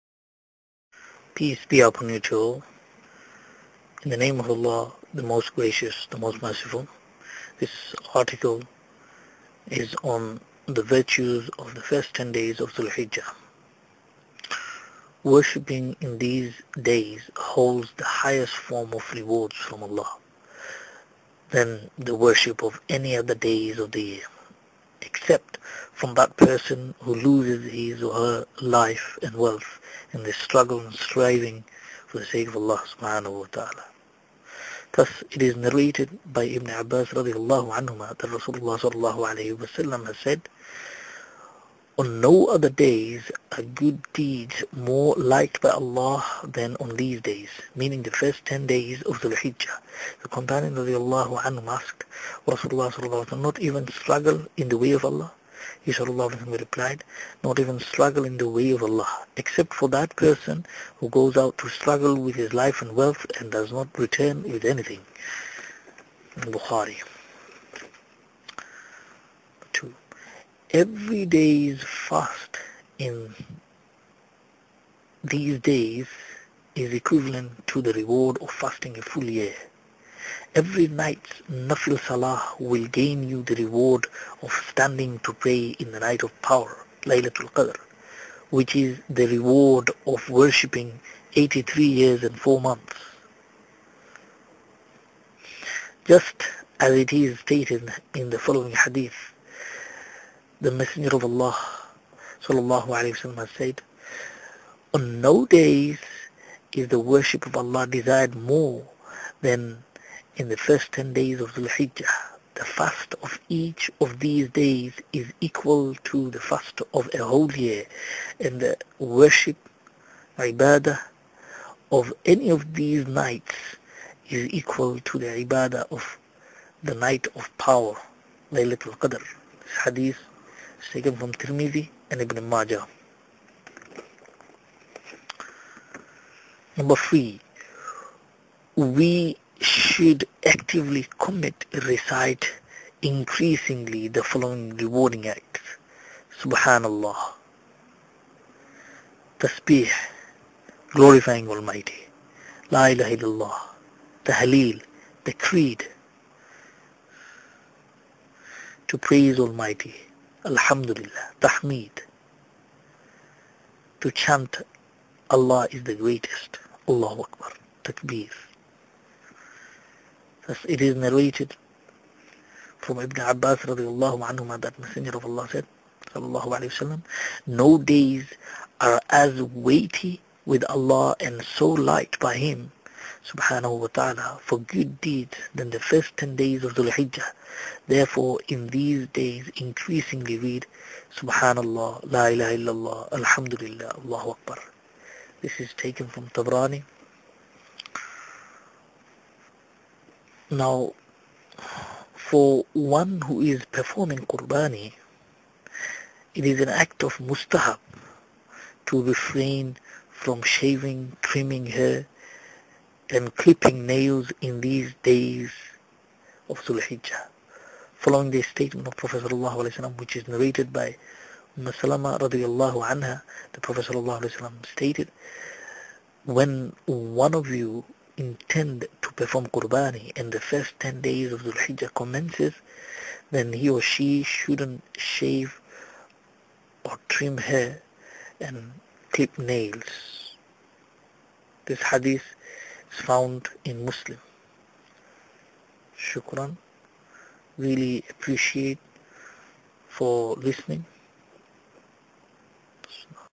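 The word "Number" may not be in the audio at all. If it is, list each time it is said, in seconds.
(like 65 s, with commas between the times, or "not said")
136 s.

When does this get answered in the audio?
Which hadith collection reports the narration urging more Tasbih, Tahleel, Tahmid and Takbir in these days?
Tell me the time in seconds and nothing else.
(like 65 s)
196 s.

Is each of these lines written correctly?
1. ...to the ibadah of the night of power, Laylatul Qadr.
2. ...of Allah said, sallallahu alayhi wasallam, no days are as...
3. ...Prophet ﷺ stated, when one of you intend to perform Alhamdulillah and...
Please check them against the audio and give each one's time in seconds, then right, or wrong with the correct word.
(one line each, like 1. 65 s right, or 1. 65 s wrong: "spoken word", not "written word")
1. 124 s right
2. 175 s right
3. 223 s wrong: "Qurbani", not "Alhamdulillah".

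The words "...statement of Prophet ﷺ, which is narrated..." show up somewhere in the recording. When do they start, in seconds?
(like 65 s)
218 s.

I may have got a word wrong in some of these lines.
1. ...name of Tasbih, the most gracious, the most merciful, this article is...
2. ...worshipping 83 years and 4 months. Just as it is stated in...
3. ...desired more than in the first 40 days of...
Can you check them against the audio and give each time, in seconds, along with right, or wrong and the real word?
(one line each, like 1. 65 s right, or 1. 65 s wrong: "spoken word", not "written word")
1. 4 s wrong: "Allah", not "Tasbih"
2. 90 s right
3. 107 s wrong: "10", not "40".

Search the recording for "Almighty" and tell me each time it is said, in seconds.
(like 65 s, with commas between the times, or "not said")
151 s, 159 s.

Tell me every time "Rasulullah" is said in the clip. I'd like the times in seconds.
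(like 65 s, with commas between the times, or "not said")
38 s, 52 s.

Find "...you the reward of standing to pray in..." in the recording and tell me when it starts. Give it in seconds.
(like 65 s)
83 s.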